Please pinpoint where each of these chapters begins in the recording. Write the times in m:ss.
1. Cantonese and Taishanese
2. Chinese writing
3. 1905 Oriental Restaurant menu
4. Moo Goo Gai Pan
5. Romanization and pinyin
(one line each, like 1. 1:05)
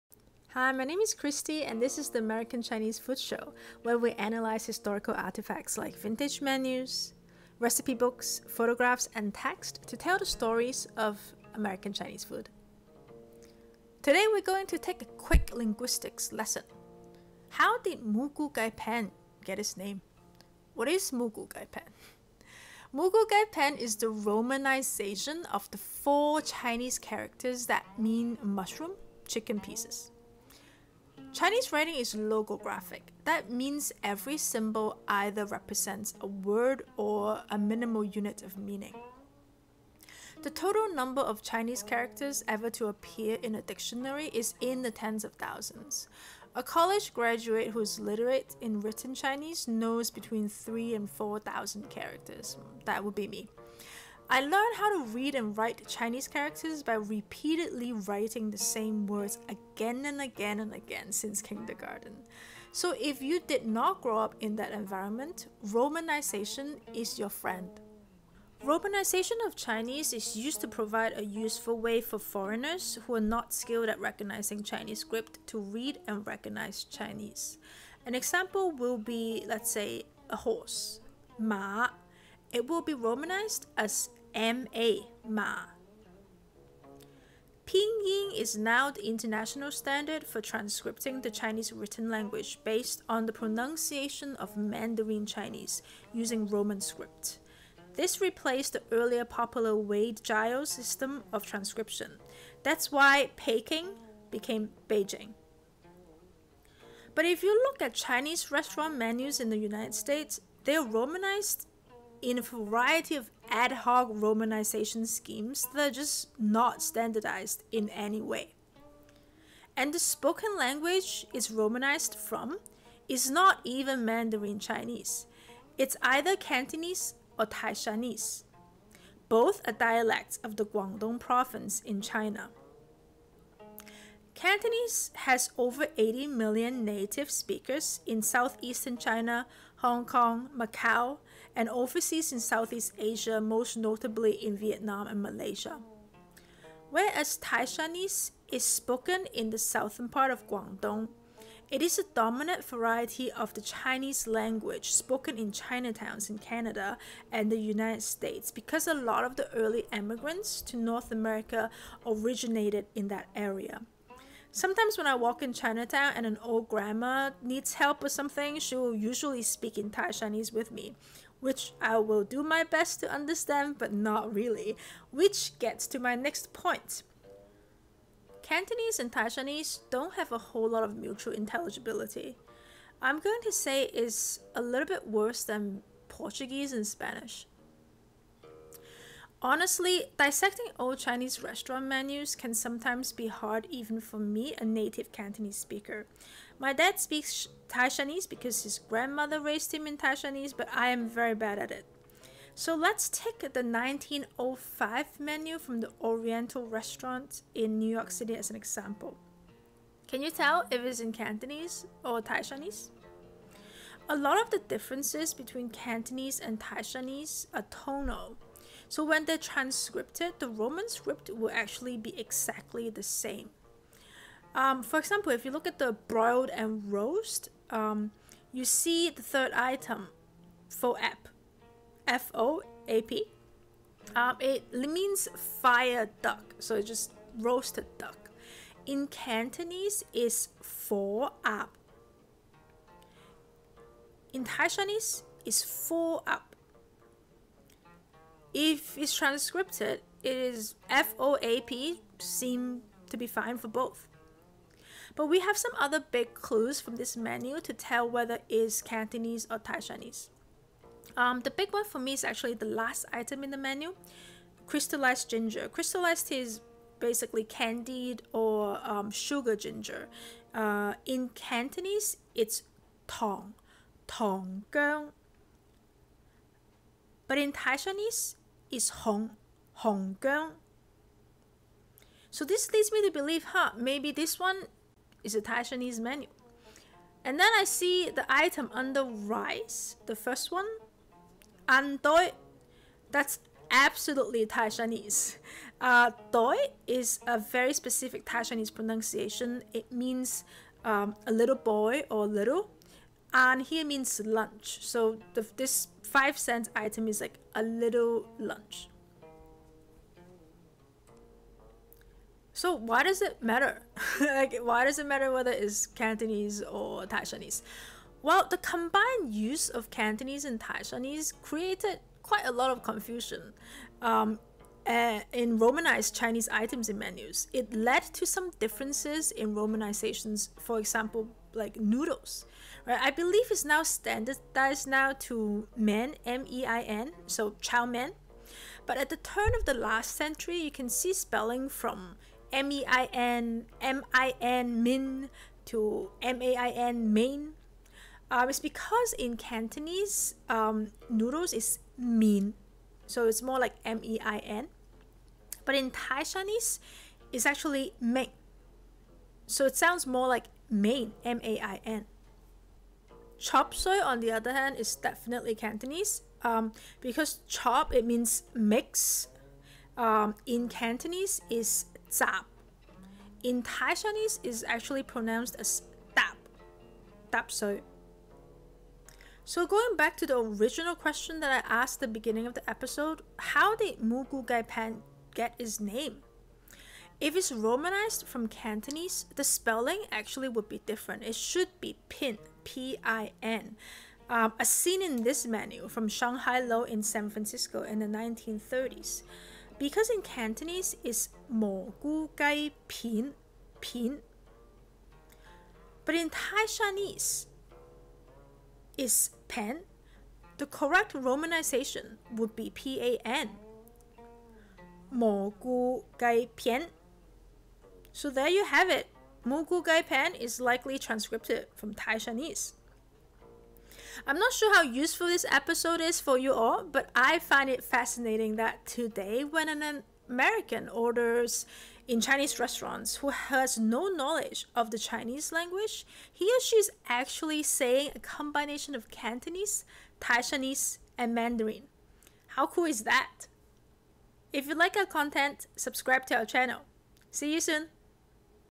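1. 1:59
2. 0:32
3. 3:24
4. 6:19
5. 1:08.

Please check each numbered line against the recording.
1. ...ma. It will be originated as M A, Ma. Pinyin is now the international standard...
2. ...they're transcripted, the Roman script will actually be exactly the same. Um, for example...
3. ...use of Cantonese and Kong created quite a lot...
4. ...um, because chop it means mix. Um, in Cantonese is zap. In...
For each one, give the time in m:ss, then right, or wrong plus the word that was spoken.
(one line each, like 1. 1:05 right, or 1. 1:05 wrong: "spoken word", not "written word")
1. 1:21 wrong: "romanized", not "originated"
2. 3:39 right
3. 5:19 wrong: "Taishanese", not "Kong"
4. 6:06 right.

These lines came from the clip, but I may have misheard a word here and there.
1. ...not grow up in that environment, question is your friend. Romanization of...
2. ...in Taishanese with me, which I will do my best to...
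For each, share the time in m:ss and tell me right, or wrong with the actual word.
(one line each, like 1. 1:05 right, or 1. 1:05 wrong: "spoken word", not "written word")
1. 1:03 wrong: "romanization", not "question"
2. 2:49 right.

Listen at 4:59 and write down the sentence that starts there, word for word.
It means um, a little boy or little and here means lunch.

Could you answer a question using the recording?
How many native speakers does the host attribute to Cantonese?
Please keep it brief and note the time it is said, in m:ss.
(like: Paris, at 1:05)
Over 80 million, at 2:15.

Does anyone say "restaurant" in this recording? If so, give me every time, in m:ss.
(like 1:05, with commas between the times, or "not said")
1:48, 3:11, 3:26, 7:12.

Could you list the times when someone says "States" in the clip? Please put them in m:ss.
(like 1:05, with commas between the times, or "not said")
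1:49, 2:38.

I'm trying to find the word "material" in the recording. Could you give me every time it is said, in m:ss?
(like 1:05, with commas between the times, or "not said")
not said.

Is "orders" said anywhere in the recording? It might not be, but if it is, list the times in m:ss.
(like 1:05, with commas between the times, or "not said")
7:10.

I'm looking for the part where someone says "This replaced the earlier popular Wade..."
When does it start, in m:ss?
1:37.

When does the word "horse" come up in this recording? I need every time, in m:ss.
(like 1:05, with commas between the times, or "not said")
1:20.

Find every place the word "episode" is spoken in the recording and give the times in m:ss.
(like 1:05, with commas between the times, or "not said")
6:22, 7:05.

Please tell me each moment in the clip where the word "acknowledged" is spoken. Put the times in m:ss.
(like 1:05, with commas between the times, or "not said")
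not said.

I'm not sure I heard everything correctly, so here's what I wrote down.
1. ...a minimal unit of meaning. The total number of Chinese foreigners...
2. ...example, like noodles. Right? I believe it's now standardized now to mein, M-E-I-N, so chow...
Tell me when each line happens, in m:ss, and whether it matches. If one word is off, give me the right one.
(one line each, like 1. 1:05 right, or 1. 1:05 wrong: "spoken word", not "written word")
1. 0:37 wrong: "characters", not "foreigners"
2. 5:30 right.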